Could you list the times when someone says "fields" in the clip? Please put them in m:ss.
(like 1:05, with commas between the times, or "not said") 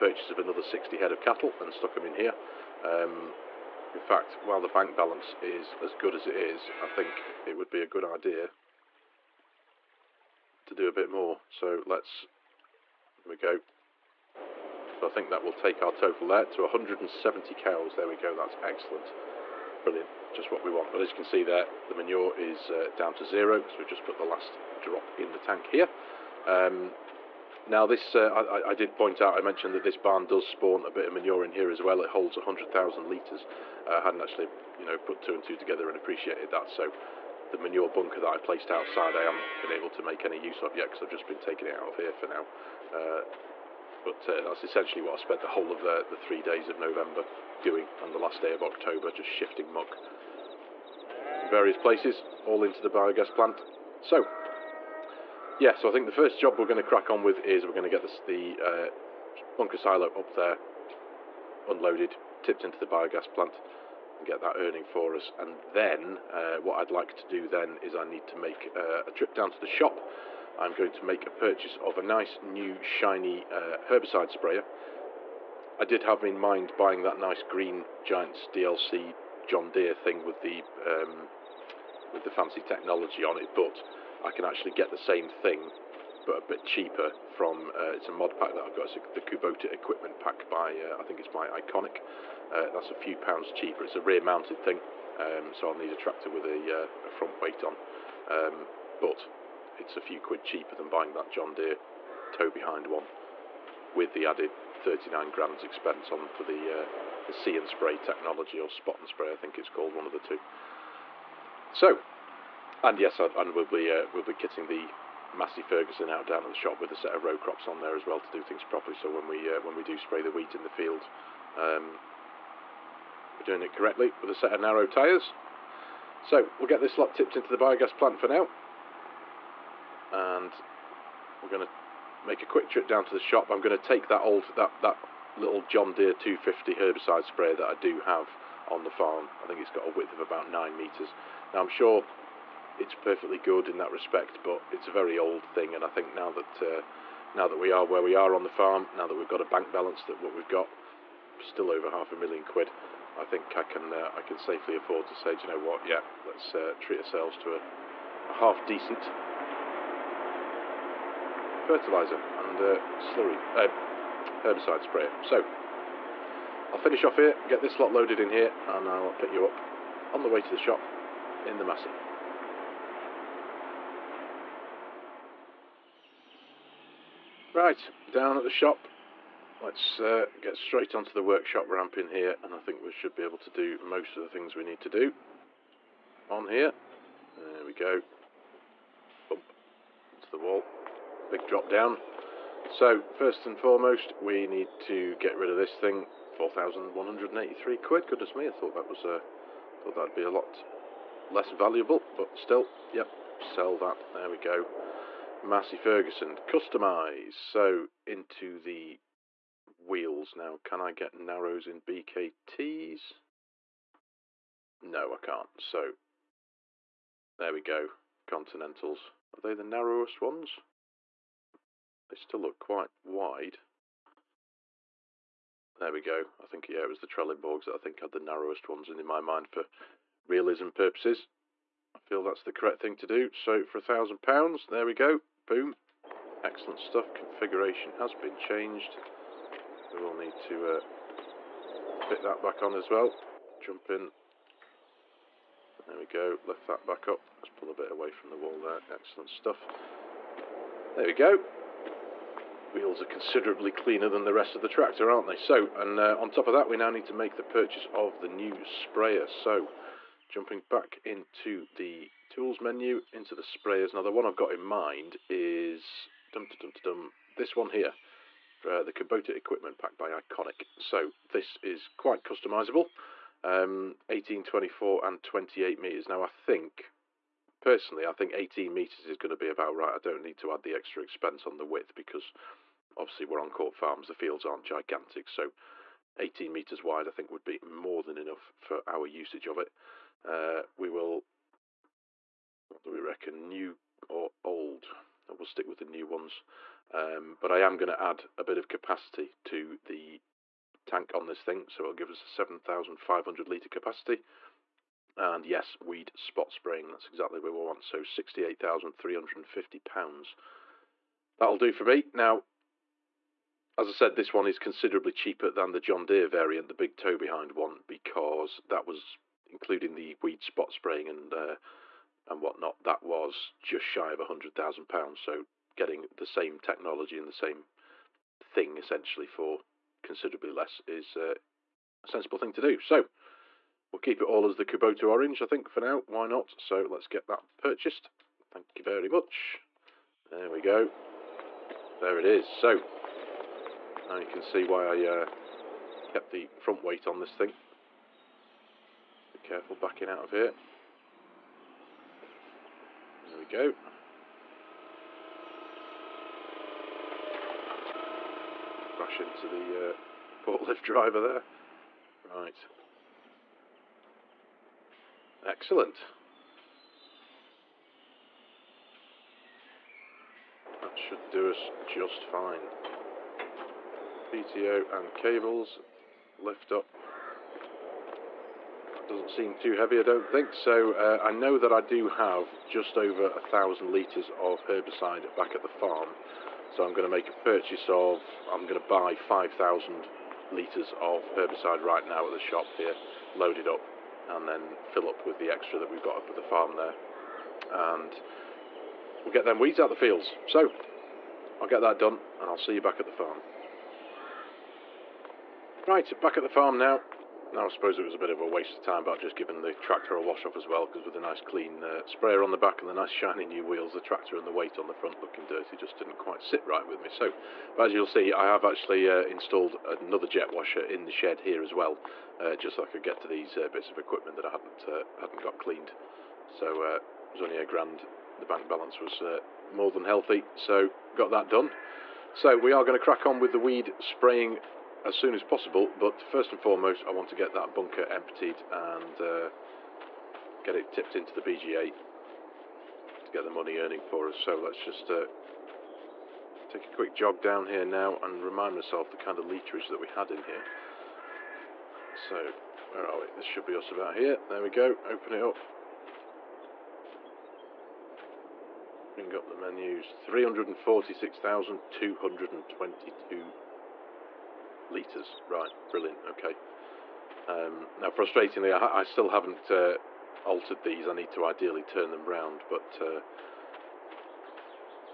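2:00, 4:44, 6:39.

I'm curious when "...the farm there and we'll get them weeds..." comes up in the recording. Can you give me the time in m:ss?
6:36.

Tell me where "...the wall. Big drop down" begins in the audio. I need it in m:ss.
3:10.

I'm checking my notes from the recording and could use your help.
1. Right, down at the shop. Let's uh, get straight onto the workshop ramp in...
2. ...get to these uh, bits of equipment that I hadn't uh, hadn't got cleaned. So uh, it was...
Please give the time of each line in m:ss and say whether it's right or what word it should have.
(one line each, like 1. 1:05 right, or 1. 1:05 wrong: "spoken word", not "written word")
1. 2:57 right
2. 7:03 right.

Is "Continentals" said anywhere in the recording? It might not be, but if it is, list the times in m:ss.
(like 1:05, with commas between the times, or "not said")
3:38.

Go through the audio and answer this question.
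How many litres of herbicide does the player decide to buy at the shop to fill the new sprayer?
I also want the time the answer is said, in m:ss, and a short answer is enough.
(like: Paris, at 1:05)
5,000 litres, at 6:29.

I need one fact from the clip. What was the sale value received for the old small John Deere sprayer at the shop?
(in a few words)
4,183 pounds.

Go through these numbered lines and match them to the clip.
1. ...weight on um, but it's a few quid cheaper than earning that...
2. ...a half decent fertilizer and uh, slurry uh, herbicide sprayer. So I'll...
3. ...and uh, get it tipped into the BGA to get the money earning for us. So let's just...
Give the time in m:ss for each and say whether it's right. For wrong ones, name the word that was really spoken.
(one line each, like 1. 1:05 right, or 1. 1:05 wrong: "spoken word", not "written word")
1. 1:37 wrong: "buying", not "earning"
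2. 2:38 right
3. 7:18 right.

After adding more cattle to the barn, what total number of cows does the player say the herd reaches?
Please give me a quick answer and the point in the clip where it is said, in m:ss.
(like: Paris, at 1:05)
170, at 0:16.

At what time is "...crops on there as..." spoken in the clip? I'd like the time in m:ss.
1:57.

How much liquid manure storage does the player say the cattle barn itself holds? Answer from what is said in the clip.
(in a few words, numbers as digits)
100,000 litres.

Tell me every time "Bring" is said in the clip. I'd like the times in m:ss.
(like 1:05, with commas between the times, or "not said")
7:39.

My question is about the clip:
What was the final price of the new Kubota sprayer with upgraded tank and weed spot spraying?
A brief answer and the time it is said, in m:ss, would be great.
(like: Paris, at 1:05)
£68,350, at 5:07.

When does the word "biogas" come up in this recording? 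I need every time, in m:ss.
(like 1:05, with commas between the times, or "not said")
0:52, 1:02, 2:07.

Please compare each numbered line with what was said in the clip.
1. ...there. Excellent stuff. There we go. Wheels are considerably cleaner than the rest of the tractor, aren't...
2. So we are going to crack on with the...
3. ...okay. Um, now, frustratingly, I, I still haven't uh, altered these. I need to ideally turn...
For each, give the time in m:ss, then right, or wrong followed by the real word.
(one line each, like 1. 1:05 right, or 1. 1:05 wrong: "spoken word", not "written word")
1. 4:08 right
2. 7:12 right
3. 7:46 right.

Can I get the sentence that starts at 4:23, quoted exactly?
Now, the one I've got in mind is dum dum dum this one here for uh, the Kubota equipment pack by Iconic.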